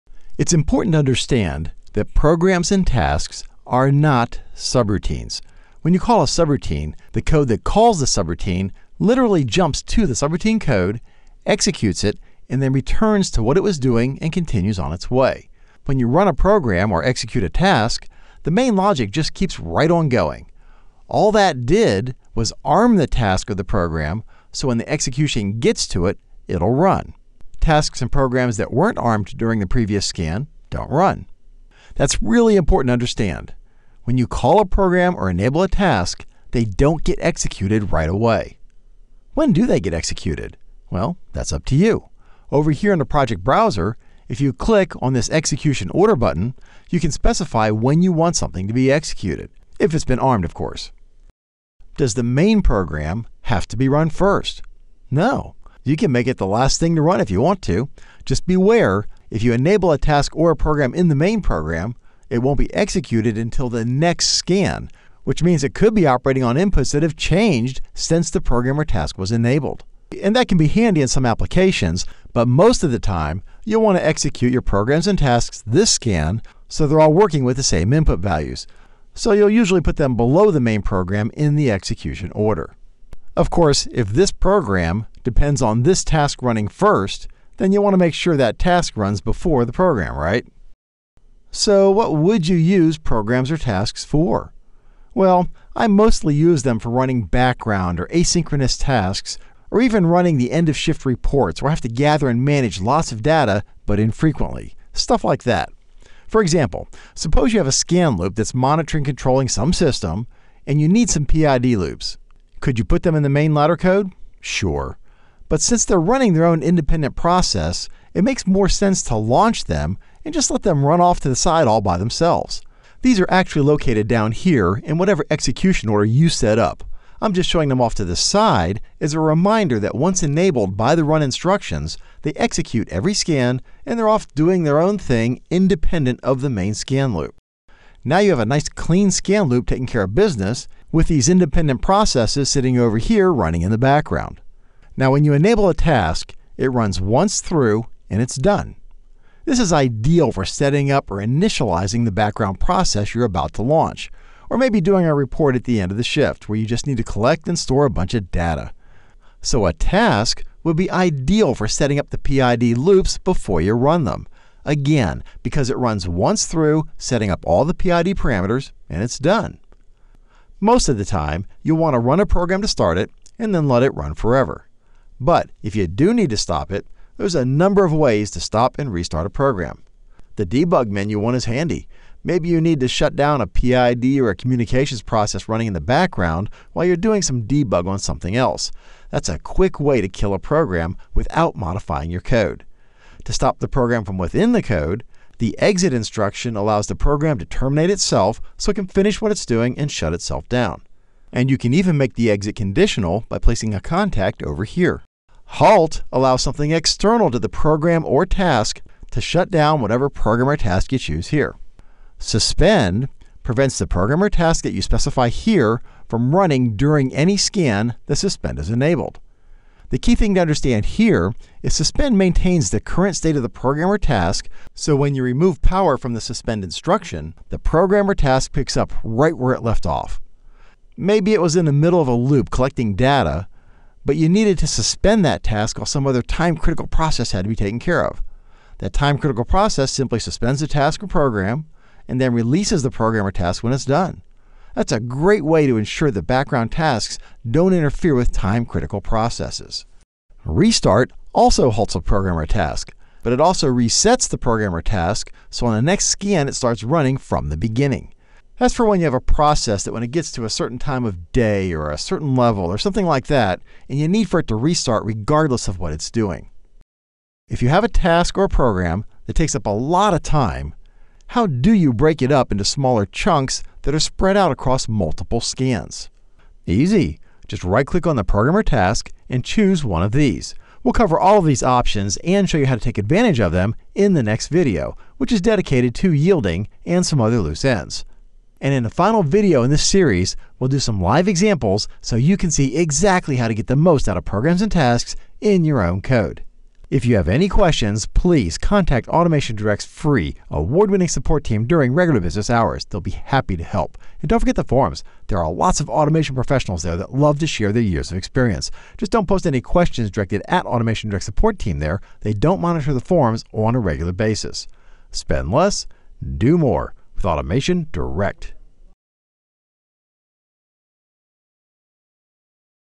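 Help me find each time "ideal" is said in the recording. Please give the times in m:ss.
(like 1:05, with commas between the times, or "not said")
2:29, 2:40.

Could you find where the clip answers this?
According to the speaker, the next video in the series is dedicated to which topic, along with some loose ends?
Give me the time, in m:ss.
4:46.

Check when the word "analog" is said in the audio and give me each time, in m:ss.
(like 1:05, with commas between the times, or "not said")
not said.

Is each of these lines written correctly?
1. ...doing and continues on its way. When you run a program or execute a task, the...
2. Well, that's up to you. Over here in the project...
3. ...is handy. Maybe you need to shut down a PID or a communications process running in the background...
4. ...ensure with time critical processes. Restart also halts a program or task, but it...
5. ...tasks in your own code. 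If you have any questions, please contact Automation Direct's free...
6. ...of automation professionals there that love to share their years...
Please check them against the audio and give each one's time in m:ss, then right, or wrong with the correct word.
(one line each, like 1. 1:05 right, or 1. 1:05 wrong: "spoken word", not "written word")
1. 0:13 right
2. 0:40 right
3. 3:01 right
4. 4:07 wrong: "interfere", not "ensure"
5. 4:54 right
6. 5:05 right.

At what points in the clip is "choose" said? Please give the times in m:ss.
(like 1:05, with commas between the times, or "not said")
3:30, 4:39.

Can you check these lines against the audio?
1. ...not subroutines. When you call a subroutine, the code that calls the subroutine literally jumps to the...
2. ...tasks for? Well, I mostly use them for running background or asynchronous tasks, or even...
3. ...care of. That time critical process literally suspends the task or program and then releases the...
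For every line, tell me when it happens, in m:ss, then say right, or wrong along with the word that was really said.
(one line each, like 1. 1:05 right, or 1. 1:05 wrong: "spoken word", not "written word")
1. 0:03 right
2. 1:33 right
3. 3:57 wrong: "simply", not "literally".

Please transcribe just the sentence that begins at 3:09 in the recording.
That's a quick way to kill a program without modifying your code.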